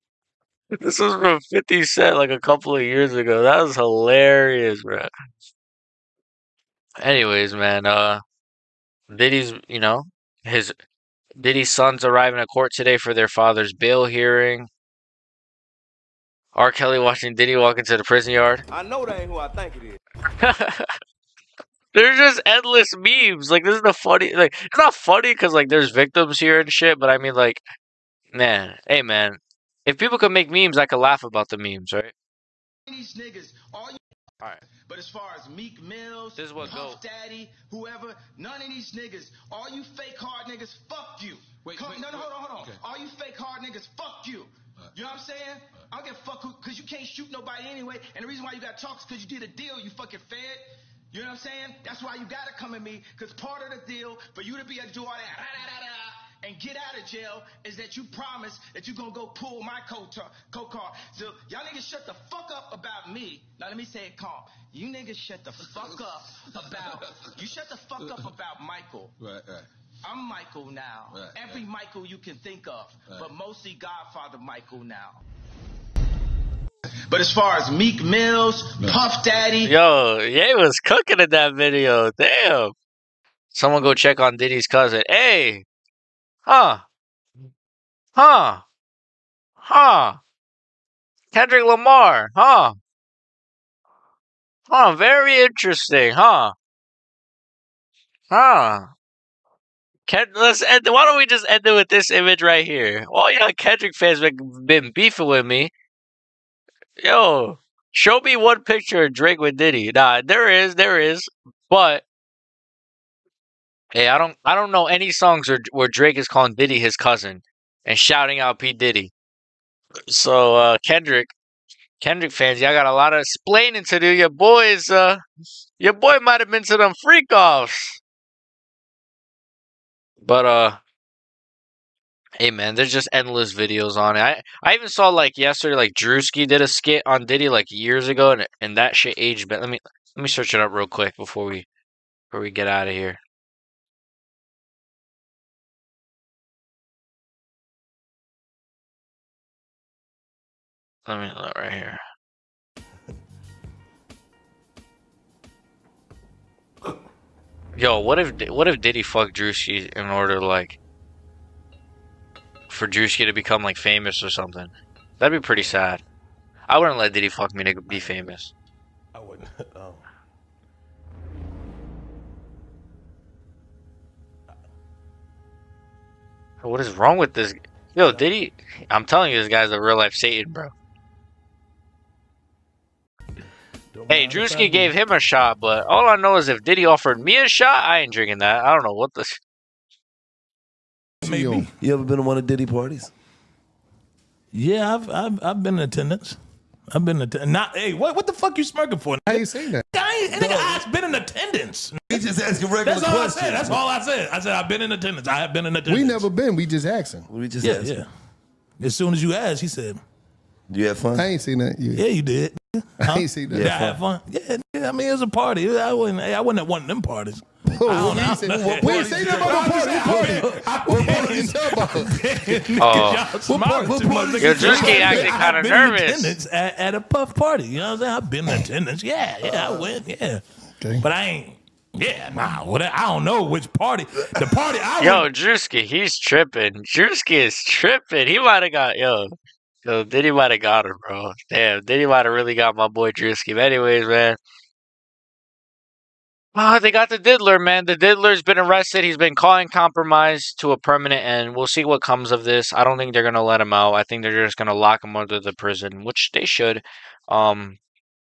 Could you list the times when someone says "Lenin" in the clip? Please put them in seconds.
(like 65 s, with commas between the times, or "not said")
not said.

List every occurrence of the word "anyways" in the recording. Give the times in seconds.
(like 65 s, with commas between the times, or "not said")
6 s, 47 s, 243 s.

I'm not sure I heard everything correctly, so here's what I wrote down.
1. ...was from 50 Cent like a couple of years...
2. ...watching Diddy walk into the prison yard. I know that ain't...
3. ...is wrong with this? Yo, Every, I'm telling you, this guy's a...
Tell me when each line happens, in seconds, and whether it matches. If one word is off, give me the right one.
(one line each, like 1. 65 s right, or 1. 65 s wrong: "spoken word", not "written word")
1. 0 s right
2. 16 s right
3. 176 s wrong: "Diddy", not "Every".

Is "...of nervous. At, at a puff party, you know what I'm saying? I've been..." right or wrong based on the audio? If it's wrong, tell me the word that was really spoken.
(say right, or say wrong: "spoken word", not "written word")
right.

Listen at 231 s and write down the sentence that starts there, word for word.
Yeah, nah, what, I don't know which party.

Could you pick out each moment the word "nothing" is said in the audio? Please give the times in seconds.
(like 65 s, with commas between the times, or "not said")
219 s.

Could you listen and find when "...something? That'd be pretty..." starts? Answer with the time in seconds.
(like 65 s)
164 s.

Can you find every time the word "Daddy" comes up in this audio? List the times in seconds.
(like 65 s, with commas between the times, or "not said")
37 s, 79 s.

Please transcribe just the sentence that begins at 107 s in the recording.
Yo, show me one picture of Drake with Diddy.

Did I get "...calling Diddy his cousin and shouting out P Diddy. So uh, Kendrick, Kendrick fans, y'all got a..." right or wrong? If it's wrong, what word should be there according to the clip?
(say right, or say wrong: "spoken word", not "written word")
right.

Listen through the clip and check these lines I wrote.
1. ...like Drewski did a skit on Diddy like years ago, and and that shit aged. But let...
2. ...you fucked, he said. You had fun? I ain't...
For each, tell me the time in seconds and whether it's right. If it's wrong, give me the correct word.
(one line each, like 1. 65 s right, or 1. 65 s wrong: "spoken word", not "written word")
1. 135 s right
2. 209 s wrong: "asked", not "fucked".